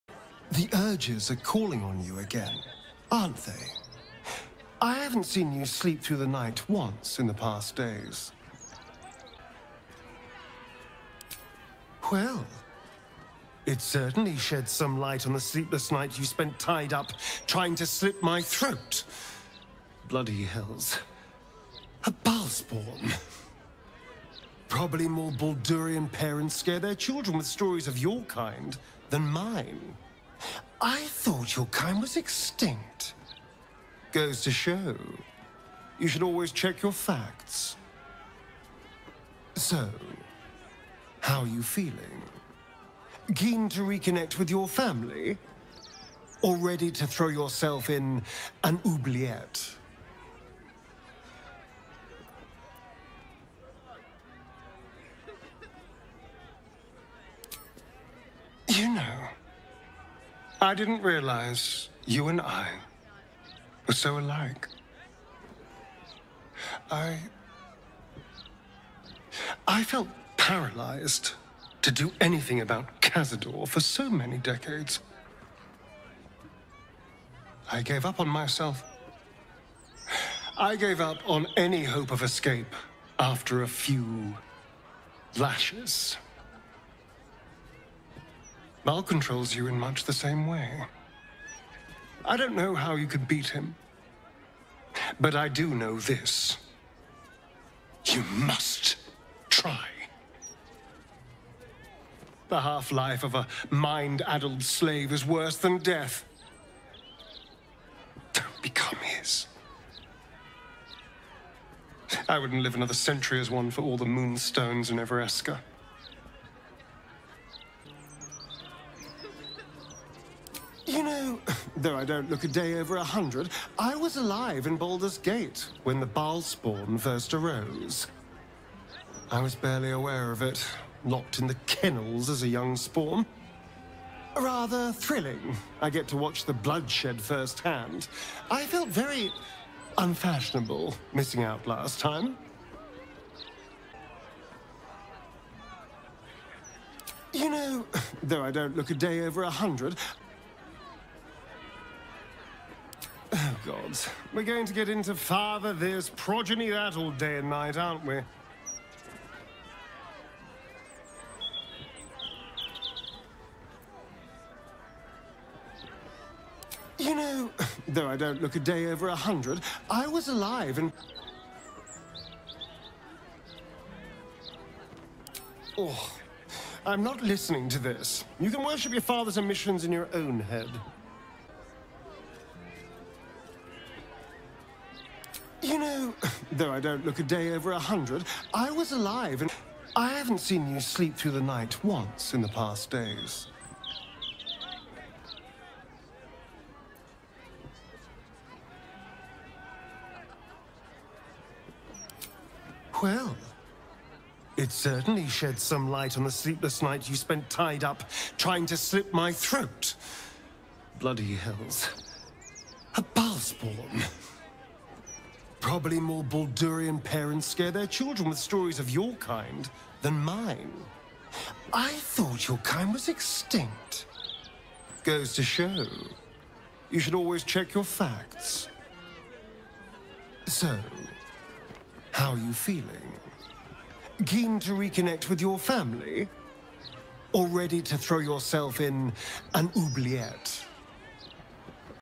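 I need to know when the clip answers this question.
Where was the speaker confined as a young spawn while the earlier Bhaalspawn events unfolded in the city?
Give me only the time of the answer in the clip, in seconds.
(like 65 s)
131 s.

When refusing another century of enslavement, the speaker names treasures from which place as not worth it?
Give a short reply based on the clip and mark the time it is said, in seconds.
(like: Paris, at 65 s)
Evereska, at 114 s.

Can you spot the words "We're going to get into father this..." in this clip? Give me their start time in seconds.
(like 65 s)
154 s.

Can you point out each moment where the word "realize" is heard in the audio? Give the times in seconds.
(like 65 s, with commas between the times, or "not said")
61 s.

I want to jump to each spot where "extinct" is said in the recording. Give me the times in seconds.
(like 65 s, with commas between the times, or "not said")
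32 s, 223 s.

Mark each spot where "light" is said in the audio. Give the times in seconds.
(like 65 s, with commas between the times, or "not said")
14 s, 205 s.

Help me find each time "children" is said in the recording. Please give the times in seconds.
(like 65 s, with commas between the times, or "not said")
26 s, 217 s.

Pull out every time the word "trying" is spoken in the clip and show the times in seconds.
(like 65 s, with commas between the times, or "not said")
17 s, 208 s.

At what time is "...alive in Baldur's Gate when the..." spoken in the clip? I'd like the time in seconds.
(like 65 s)
124 s.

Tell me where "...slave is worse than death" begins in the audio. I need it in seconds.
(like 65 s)
104 s.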